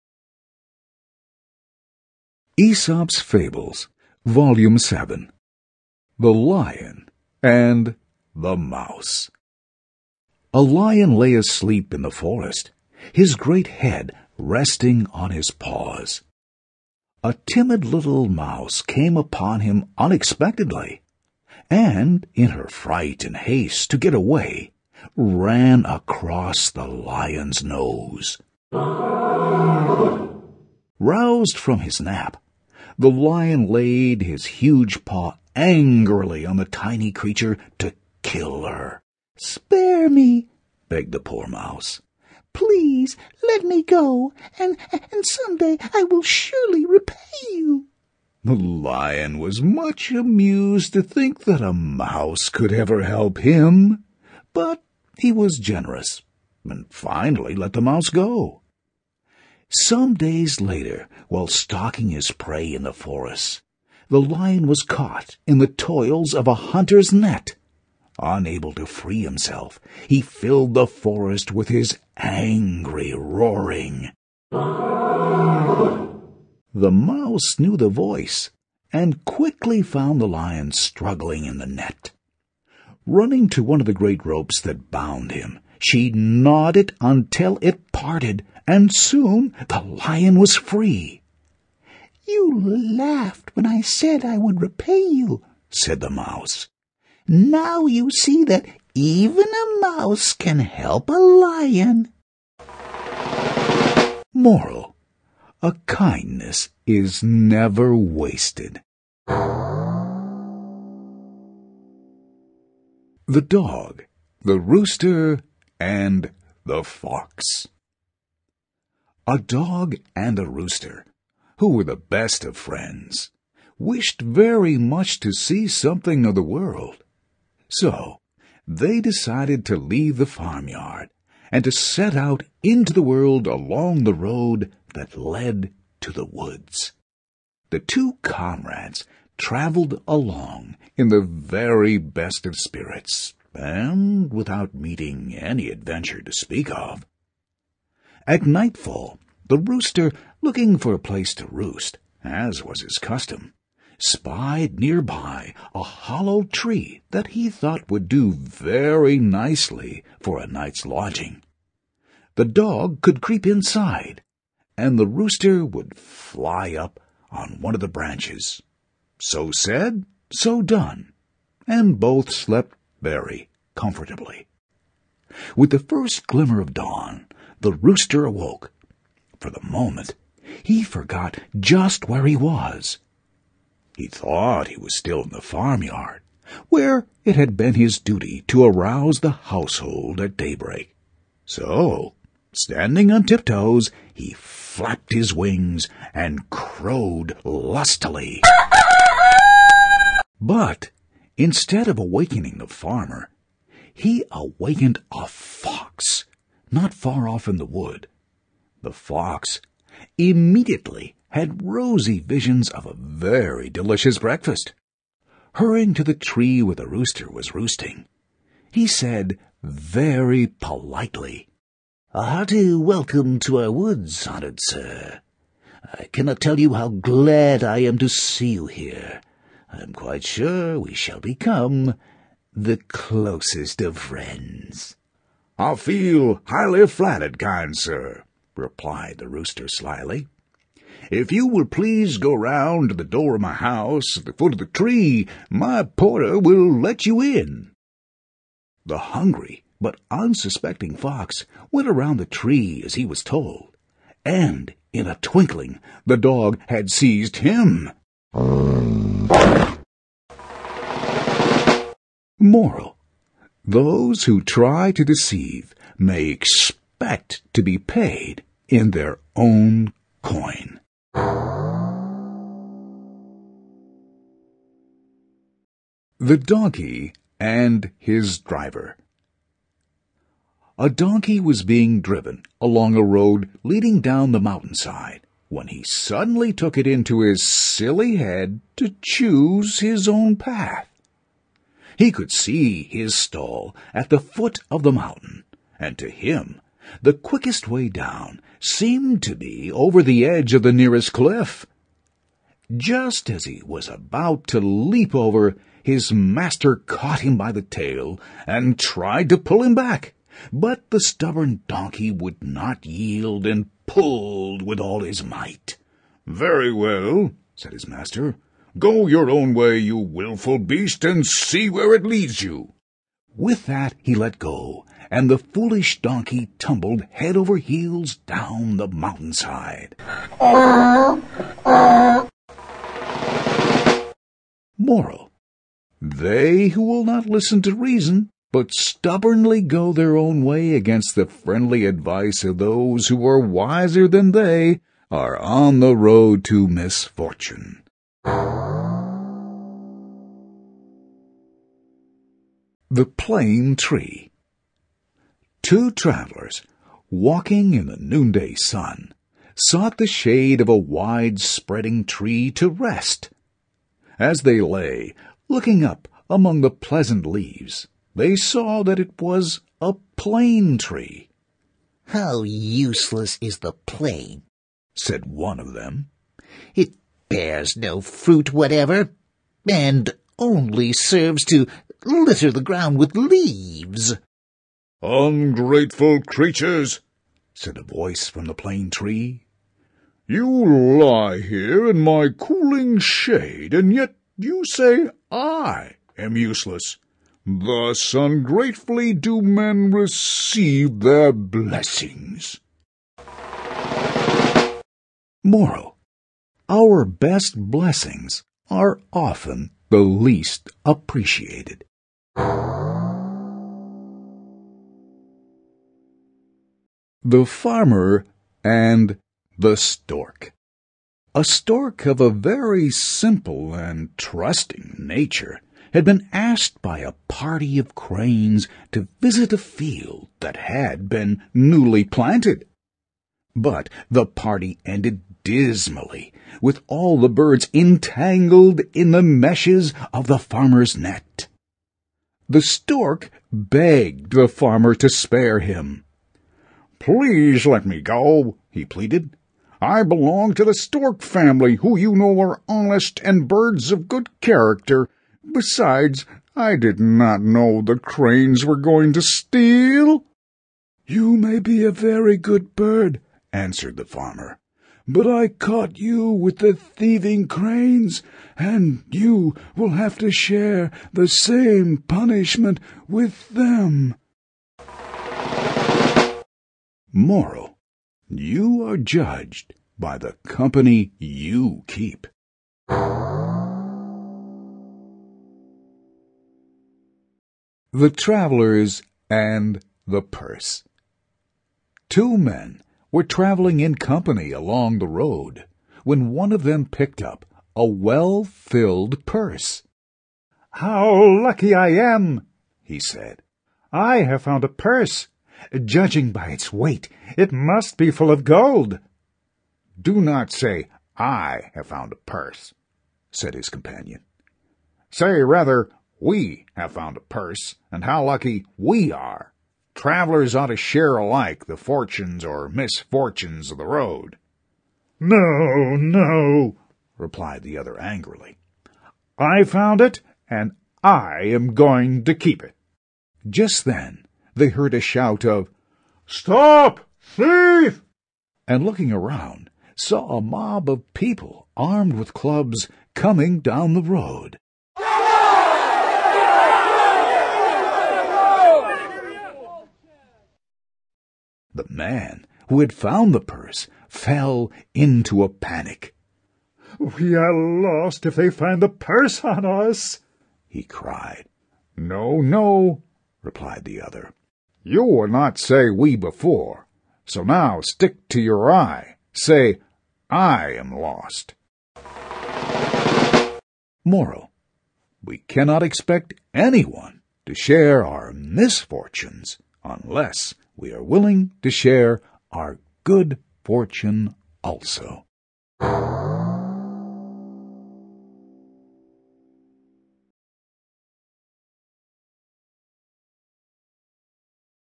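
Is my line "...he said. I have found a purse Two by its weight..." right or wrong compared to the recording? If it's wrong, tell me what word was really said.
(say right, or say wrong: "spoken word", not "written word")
wrong: "Judging", not "Two".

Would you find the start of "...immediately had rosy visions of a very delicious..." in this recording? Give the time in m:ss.
3:30.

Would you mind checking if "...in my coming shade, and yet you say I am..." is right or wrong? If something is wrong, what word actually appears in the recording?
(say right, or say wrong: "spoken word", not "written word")
wrong: "cooling", not "coming".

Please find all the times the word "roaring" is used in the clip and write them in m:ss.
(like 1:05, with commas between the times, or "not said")
1:13.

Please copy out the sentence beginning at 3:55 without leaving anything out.
I feel highly flattered, kind sir, replied the rooster slyly.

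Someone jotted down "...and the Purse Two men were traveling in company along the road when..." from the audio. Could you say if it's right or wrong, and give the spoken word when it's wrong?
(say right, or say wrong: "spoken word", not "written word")
right.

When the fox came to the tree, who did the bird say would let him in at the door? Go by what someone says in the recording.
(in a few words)
My porter.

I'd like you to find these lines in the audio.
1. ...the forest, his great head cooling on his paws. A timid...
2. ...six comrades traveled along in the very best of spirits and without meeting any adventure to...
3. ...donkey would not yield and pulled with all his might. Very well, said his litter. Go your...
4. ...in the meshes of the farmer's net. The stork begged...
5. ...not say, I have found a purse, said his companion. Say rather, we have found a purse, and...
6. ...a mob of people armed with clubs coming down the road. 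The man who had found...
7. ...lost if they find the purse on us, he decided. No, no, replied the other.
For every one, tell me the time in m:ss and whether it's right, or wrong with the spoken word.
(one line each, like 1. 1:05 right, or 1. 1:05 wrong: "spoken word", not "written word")
1. 0:12 wrong: "resting", not "cooling"
2. 2:17 wrong: "two", not "six"
3. 5:11 wrong: "master", not "litter"
4. 7:18 right
5. 8:30 right
6. 9:00 right
7. 9:17 wrong: "cried", not "decided".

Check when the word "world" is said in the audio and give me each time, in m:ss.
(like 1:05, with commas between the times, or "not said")
2:06, 2:13.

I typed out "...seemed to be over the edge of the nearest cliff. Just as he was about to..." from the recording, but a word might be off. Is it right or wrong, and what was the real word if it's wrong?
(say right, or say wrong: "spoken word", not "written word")
right.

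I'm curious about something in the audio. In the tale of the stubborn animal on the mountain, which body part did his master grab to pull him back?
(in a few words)
The tail.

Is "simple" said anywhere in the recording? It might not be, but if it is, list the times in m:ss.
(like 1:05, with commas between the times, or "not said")
7:02.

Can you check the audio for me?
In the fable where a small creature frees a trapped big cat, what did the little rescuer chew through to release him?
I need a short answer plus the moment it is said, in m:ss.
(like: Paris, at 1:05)
The great ropes, at 1:23.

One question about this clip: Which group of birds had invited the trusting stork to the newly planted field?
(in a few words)
A party of cranes.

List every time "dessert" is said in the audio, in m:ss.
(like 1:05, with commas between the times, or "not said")
not said.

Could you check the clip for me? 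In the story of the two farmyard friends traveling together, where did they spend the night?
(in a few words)
A hollow tree.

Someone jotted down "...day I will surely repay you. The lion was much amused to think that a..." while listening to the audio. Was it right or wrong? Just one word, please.
right.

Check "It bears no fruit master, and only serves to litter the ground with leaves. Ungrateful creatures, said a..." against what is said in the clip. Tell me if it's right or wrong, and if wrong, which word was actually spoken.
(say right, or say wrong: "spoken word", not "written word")
wrong: "whatever", not "master".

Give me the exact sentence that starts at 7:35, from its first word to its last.
Besides, I did not know the cranes were going to steal.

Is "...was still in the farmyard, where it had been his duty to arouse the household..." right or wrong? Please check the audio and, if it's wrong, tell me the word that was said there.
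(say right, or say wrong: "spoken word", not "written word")
right.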